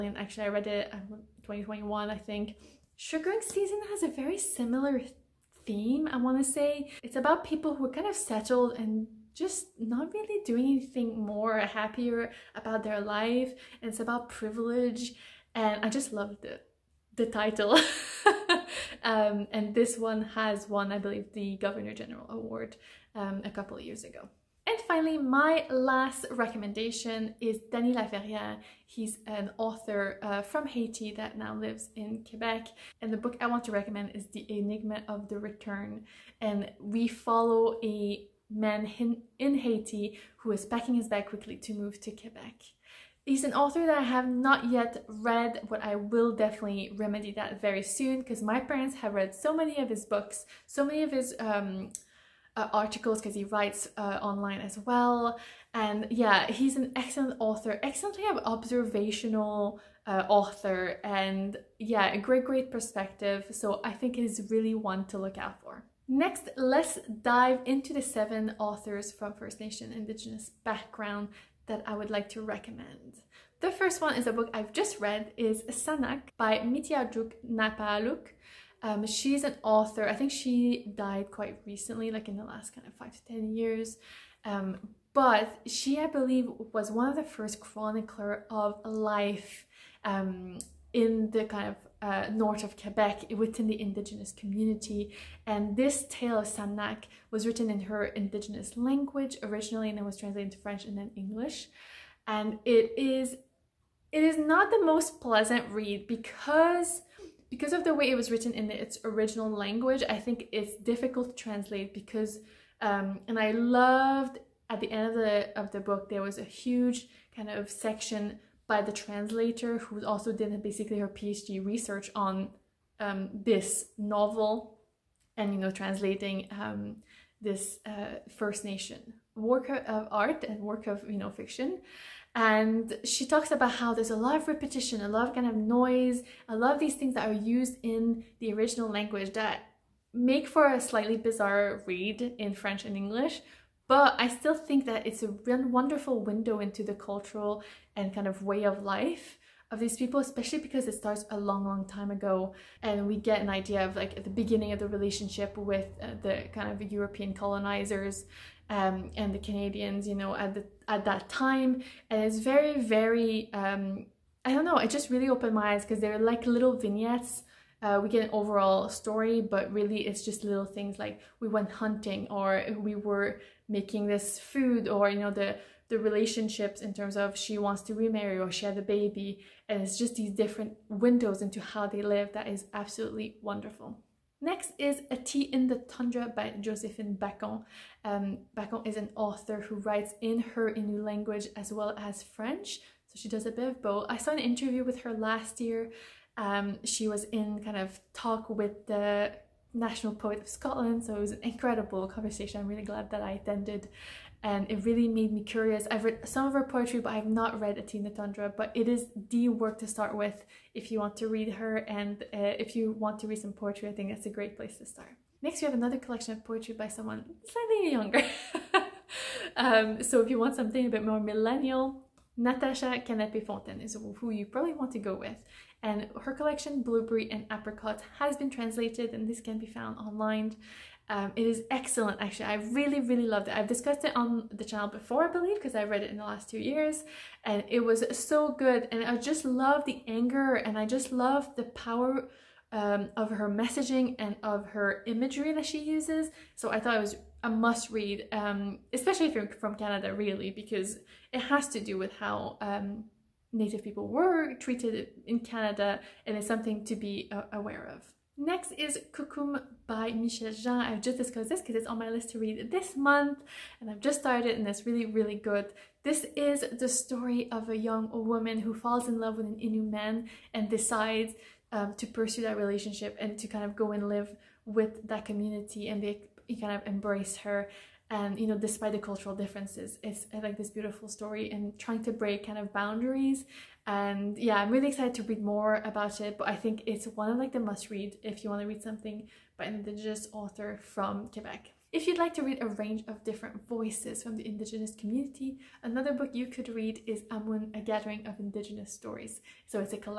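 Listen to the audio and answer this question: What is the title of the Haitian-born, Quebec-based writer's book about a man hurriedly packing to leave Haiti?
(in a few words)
The Enigma of the Return.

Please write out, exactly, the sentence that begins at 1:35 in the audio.
And this tale of Sanaaq was written in her indigenous language originally and then was translated into French and then English.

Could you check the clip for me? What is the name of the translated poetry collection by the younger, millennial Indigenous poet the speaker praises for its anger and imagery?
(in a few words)
Blueberry and Apricot.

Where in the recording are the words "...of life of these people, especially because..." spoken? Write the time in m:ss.
2:28.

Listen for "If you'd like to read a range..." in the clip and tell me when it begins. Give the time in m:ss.
4:51.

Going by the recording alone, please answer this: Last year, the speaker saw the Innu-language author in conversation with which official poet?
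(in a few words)
National Poet of Scotland.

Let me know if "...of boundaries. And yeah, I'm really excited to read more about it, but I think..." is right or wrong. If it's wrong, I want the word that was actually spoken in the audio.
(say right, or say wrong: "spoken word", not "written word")
right.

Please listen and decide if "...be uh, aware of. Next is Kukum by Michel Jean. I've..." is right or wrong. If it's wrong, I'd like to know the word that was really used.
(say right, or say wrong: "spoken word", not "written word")
right.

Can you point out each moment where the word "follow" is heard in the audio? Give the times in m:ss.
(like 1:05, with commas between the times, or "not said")
0:37.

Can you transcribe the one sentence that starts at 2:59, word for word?
And it's just these different windows into how they live that is absolutely wonderful.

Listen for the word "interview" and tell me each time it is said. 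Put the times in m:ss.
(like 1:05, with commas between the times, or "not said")
3:14.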